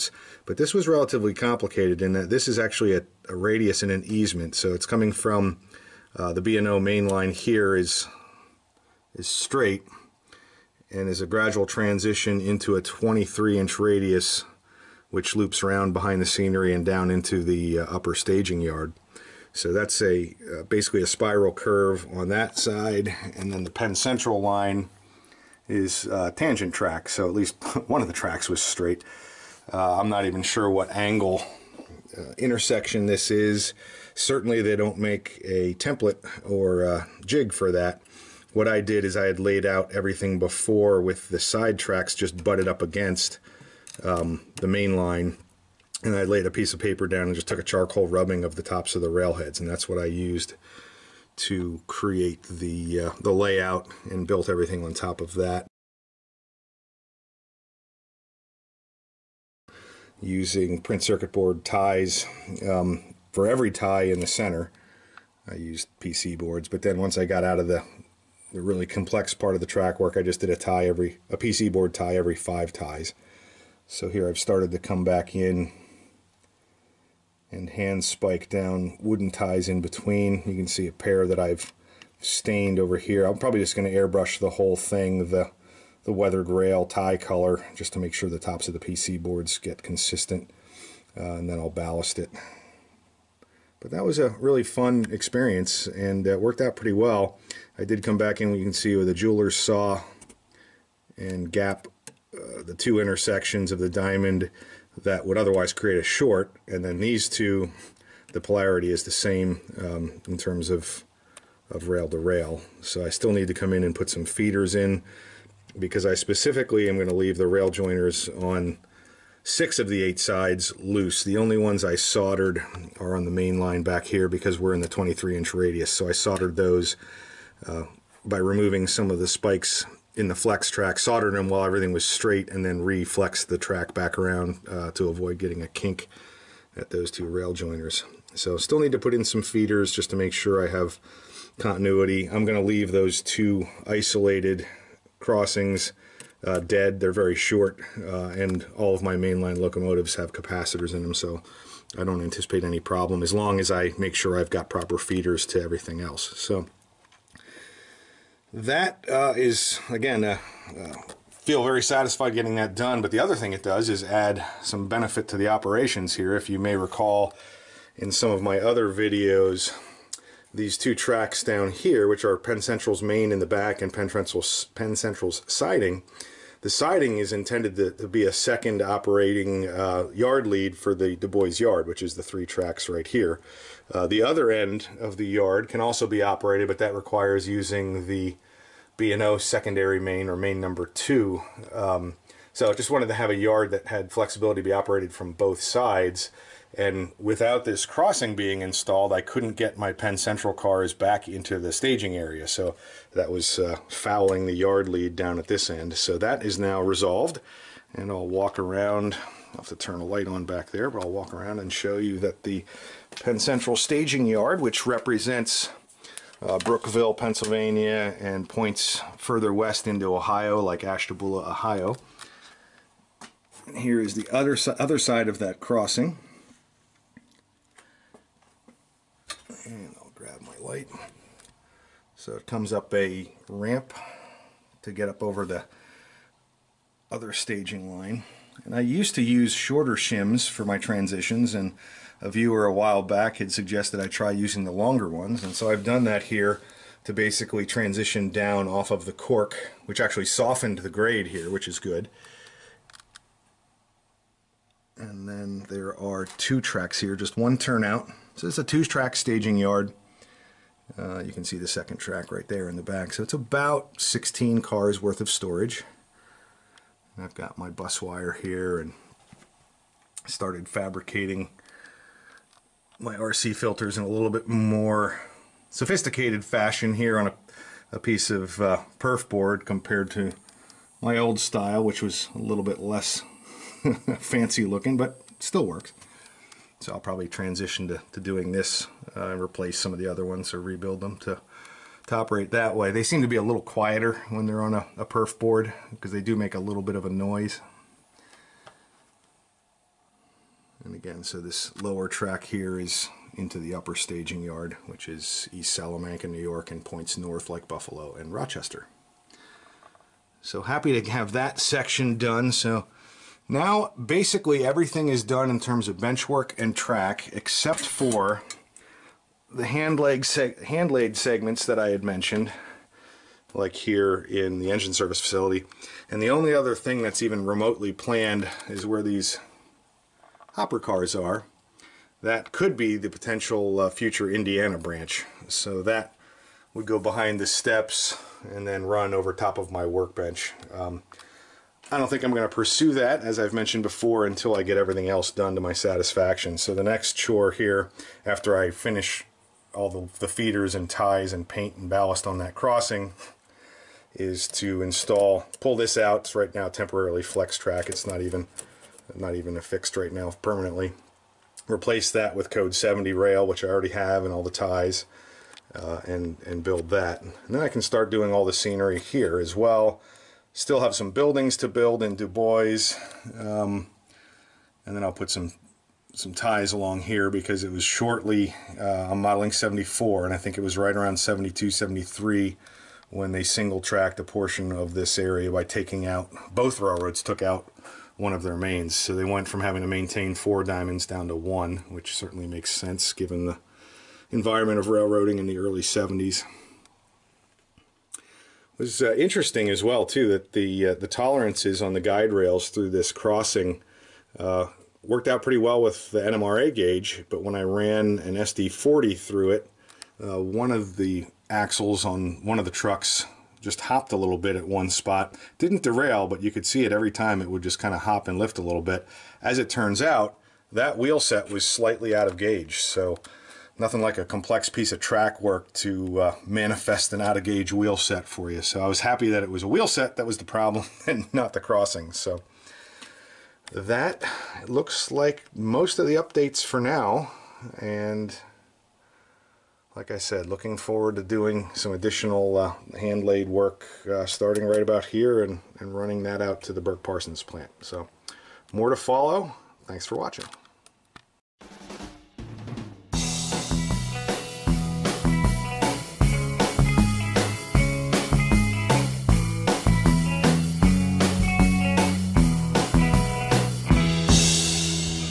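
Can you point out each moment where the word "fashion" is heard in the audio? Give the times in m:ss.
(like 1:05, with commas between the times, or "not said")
4:36.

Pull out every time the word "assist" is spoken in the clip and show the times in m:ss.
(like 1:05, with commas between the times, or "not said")
not said.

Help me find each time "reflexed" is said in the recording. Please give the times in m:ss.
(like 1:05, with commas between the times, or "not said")
2:12.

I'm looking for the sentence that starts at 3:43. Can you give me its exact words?
And Here is the other, other side of that crossing.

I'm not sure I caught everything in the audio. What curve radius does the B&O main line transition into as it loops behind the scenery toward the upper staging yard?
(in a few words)
23-inch.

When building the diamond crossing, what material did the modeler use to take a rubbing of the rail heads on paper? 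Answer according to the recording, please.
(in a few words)
Charcoal.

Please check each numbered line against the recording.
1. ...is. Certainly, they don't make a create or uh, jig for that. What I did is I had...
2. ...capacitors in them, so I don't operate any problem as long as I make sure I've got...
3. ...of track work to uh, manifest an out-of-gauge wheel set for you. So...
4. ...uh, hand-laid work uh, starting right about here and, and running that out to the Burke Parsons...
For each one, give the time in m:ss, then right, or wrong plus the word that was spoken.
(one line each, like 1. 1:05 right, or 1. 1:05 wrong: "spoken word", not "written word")
1. 0:33 wrong: "template", not "create"
2. 2:30 wrong: "anticipate", not "operate"
3. 7:04 right
4. 7:22 right.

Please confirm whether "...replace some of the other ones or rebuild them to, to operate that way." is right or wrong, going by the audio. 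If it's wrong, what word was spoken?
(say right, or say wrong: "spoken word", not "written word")
right.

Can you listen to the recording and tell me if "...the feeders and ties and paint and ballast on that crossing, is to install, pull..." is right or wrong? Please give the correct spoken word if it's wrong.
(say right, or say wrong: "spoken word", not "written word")
right.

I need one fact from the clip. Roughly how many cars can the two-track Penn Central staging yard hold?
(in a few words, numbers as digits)
16.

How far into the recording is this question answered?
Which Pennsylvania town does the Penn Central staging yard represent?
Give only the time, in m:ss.
3:36.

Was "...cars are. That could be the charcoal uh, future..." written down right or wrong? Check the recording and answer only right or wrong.
wrong.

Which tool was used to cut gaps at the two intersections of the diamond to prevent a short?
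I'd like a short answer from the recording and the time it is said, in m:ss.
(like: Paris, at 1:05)
Jeweler's saw, at 1:39.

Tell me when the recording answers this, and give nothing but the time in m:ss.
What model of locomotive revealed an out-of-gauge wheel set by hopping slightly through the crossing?
6:48.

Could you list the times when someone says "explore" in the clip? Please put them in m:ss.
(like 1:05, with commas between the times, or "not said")
not said.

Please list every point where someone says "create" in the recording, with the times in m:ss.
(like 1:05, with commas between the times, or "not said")
0:51, 1:45.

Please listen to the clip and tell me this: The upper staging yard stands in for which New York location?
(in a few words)
East Salamanca.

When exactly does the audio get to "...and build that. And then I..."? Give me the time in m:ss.
6:06.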